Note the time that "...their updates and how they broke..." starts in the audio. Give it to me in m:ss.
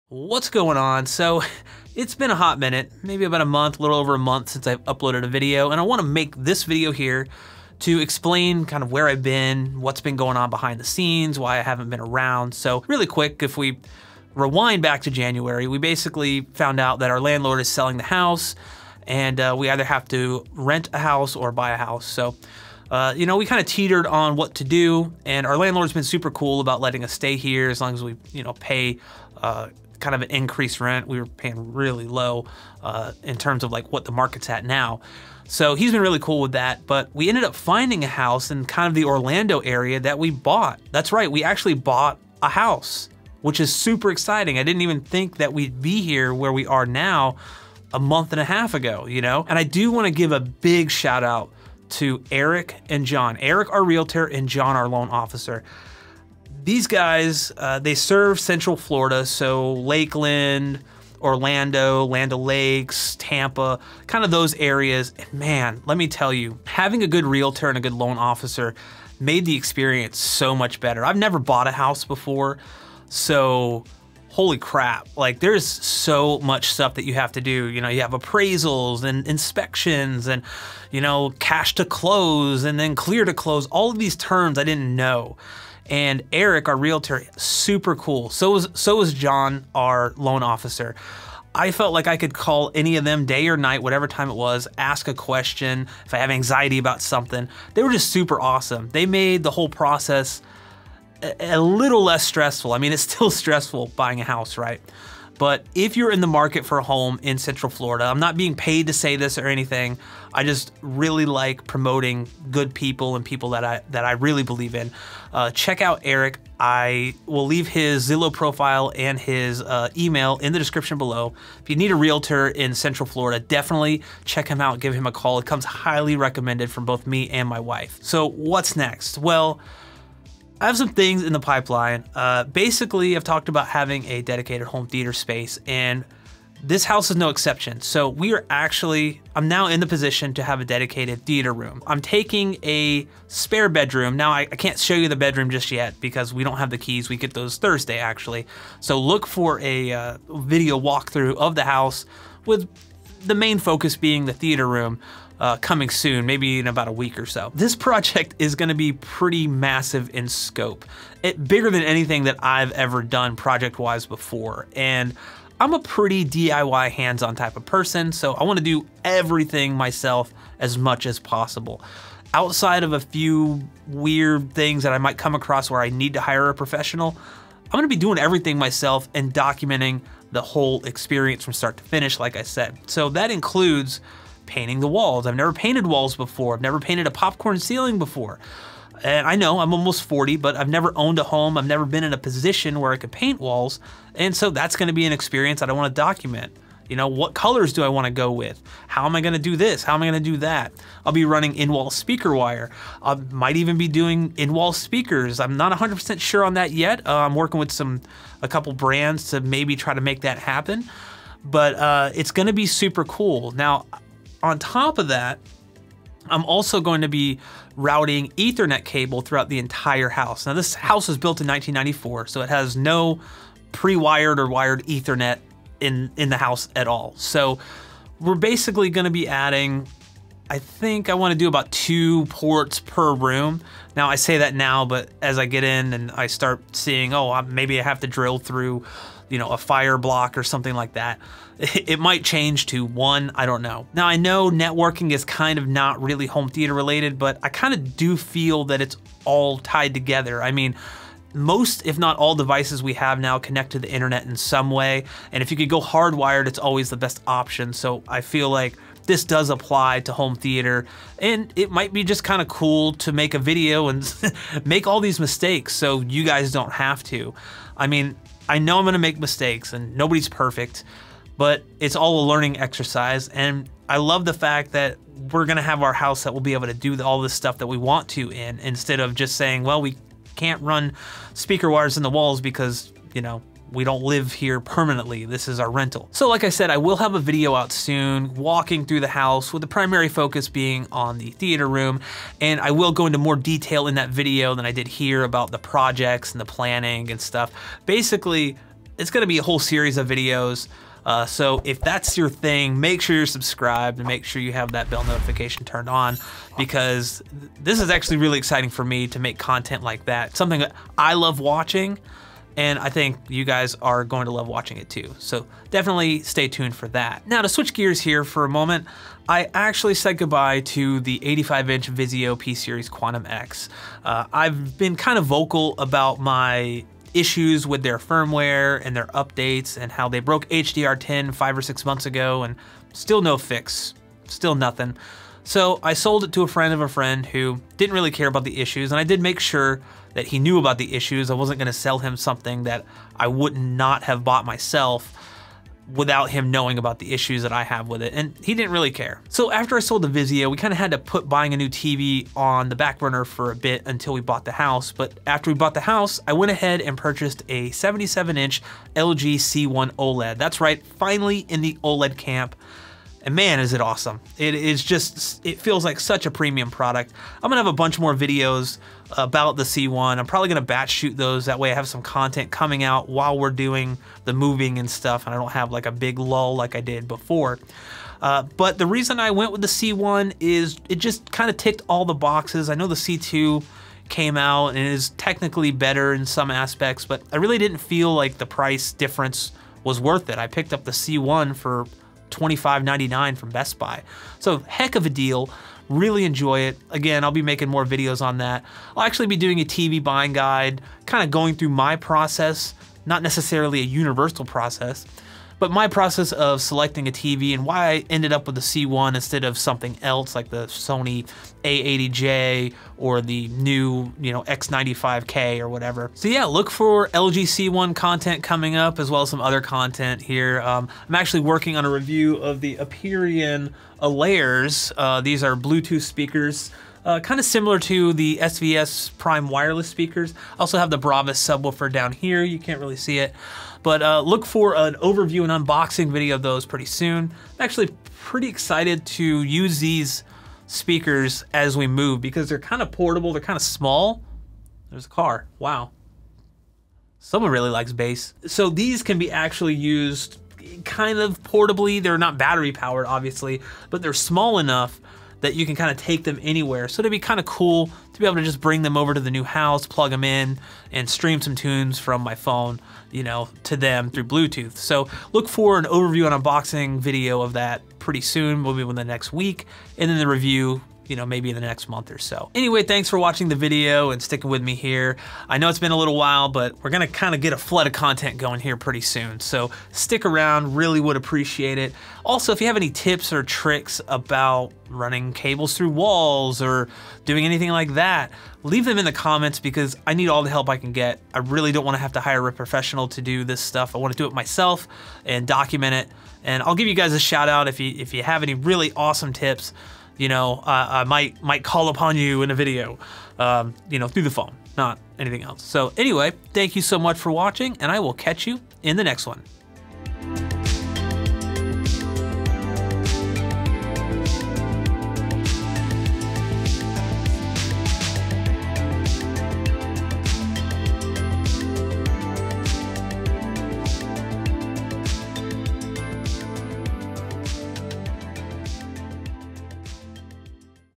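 5:28.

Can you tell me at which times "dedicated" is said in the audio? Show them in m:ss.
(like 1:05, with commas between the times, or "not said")
2:14, 2:20.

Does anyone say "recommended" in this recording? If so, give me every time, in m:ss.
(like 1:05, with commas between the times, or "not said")
2:06.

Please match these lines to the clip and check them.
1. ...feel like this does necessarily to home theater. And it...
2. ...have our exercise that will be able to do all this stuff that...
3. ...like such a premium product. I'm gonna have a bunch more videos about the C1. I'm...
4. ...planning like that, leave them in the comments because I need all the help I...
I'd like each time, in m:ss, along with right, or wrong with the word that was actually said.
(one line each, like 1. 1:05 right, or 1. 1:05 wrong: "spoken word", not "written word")
1. 4:18 wrong: "apply", not "necessarily"
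2. 4:35 wrong: "house", not "exercise"
3. 6:05 right
4. 8:07 wrong: "anything", not "planning".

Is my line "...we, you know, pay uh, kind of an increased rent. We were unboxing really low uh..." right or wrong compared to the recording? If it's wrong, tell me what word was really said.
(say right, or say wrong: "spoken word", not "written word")
wrong: "paying", not "unboxing".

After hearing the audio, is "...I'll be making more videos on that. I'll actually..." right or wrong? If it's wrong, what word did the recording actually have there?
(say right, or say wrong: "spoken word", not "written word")
right.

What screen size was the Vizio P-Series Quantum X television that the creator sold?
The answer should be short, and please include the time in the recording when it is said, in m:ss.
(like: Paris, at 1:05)
85-inch, at 5:21.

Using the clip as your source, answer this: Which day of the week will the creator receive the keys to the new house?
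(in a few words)
Thursday.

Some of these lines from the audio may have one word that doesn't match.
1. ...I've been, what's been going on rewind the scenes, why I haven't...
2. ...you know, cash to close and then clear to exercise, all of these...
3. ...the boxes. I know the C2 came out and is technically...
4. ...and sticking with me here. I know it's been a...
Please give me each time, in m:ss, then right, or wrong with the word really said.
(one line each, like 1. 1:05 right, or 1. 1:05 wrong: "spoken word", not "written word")
1. 0:09 wrong: "behind", not "rewind"
2. 1:20 wrong: "close", not "exercise"
3. 6:22 right
4. 7:54 right.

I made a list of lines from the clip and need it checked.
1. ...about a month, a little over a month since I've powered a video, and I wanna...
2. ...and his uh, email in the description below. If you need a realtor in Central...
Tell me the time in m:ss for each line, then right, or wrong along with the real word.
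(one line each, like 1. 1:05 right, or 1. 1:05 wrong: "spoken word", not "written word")
1. 0:03 wrong: "uploaded", not "powered"
2. 1:58 right.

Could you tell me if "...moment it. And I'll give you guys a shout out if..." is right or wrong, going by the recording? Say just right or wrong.
wrong.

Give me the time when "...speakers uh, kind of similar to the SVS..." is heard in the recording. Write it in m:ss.
7:06.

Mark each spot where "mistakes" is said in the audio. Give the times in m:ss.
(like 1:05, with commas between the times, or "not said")
4:25, 4:29.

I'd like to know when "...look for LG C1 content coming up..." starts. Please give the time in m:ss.
6:56.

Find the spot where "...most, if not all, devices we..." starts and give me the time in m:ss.
4:11.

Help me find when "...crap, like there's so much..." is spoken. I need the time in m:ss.
1:14.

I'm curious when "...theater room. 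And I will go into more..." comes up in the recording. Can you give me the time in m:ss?
4:51.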